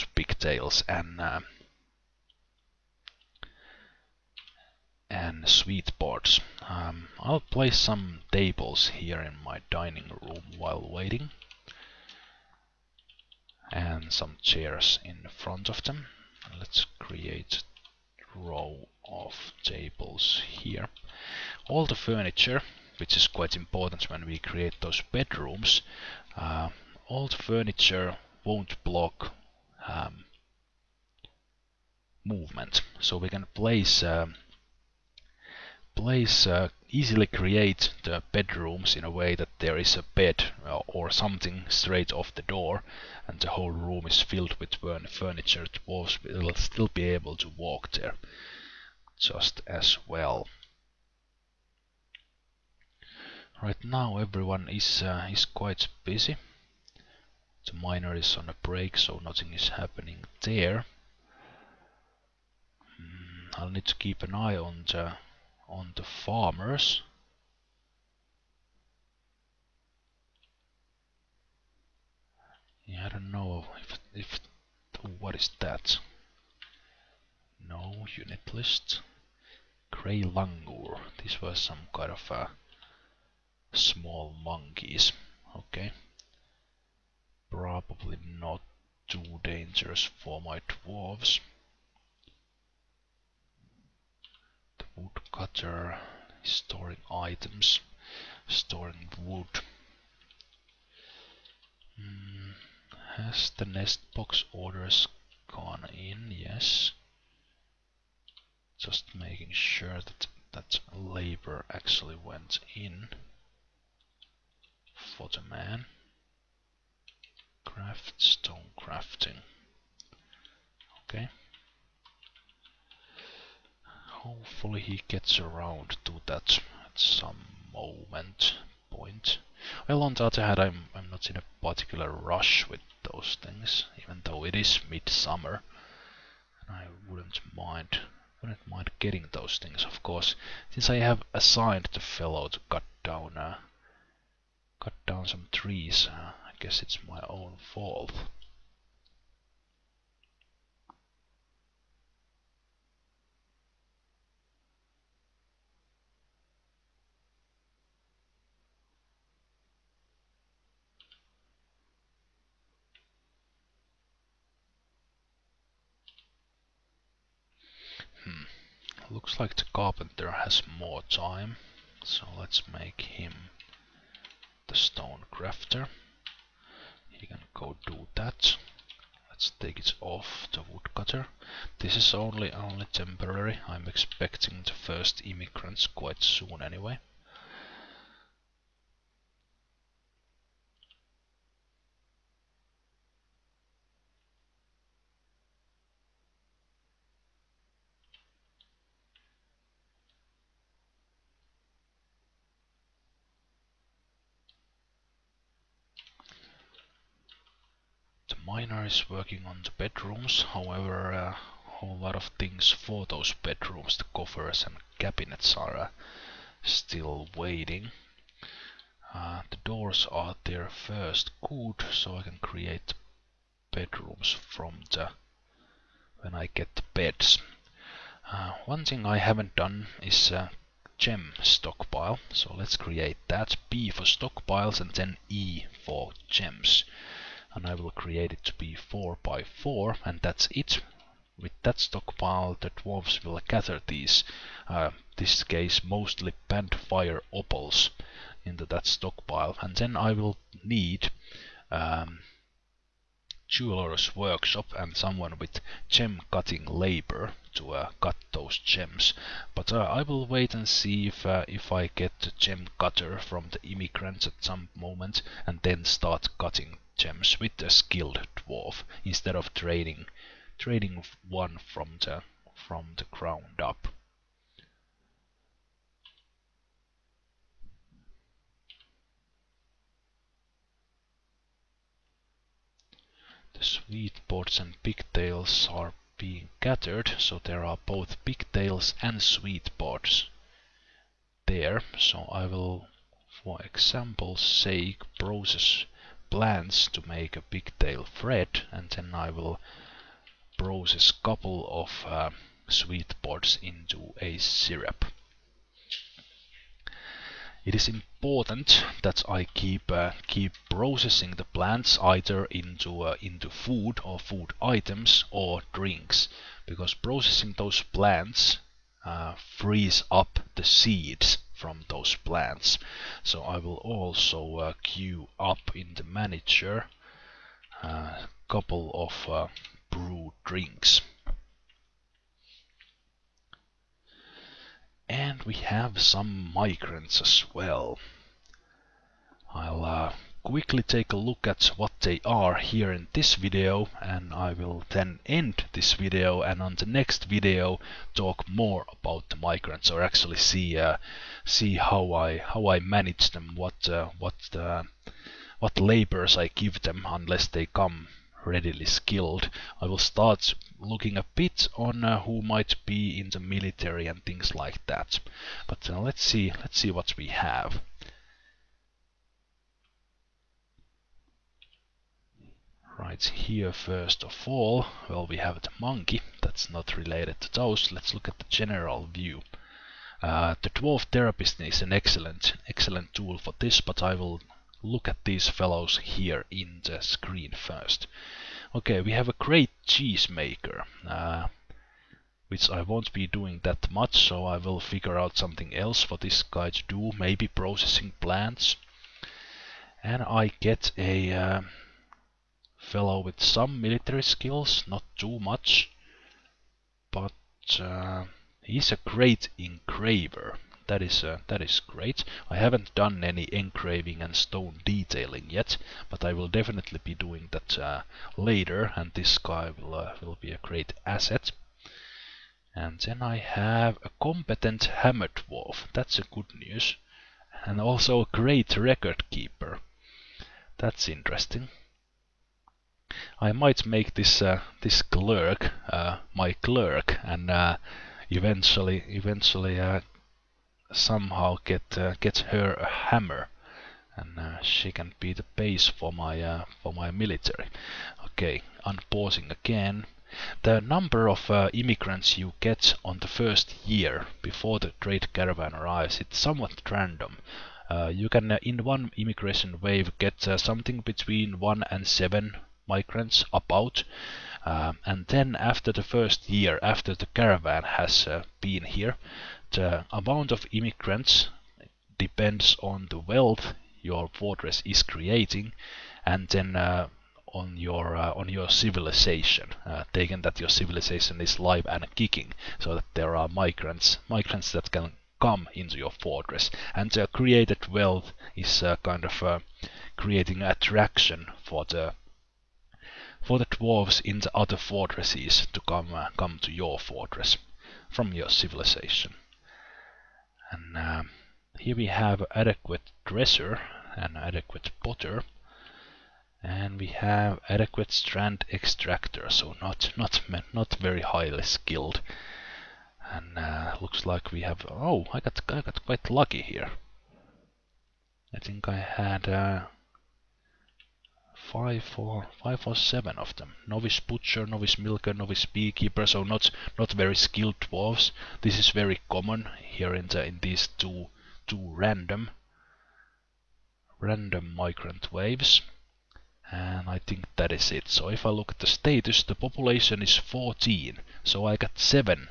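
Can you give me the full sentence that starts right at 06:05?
But uh, let's see let's see what we have.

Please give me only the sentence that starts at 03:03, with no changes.
I'm expecting the first immigrants quite soon anyway.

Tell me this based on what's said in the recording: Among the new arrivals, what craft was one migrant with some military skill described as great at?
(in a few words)
engraver.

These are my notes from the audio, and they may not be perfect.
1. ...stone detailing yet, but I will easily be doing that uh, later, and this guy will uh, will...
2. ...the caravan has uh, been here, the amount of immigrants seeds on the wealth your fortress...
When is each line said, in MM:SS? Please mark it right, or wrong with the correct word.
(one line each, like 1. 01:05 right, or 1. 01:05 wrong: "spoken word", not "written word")
1. 06:54 wrong: "definitely", not "easily"
2. 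07:47 wrong: "depends", not "seeds".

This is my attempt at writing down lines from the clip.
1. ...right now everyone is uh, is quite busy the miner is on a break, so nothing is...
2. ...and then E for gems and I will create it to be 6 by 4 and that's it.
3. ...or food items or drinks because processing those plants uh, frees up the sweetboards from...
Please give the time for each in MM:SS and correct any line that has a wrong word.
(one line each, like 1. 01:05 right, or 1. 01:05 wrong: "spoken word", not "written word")
1. 00:53 right
2. 03:54 wrong: "4", not "6"
3. 05:14 wrong: "seeds", not "sweetboards".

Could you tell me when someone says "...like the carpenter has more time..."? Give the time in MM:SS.
02:49.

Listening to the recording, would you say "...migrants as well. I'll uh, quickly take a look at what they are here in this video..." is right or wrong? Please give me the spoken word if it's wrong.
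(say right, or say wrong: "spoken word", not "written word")
right.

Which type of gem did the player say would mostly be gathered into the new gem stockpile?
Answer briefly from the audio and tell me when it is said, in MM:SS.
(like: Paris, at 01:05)
fire opals, at 04:06.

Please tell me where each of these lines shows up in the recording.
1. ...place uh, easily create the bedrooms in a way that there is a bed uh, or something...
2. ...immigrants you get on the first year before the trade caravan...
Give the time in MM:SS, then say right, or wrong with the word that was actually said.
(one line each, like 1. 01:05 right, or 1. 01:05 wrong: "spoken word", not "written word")
1. 00:35 right
2. 07:31 right.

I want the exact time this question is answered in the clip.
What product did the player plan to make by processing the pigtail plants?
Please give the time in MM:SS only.
04:57.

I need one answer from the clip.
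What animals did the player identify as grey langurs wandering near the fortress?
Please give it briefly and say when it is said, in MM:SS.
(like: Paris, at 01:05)
small monkeys, at 01:23.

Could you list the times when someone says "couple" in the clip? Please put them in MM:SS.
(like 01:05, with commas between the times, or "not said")
05:01, 05:28.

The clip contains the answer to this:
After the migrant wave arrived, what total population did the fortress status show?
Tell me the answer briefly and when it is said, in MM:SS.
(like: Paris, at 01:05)
14, at 09:00.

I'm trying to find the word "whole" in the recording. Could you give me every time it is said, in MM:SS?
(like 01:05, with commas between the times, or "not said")
00:43, 03:31.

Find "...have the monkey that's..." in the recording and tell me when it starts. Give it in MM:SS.
06:15.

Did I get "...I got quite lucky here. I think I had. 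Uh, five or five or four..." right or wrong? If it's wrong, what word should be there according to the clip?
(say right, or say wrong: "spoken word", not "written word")
wrong: "seven", not "four".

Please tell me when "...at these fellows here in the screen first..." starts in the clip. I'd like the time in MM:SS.
06:25.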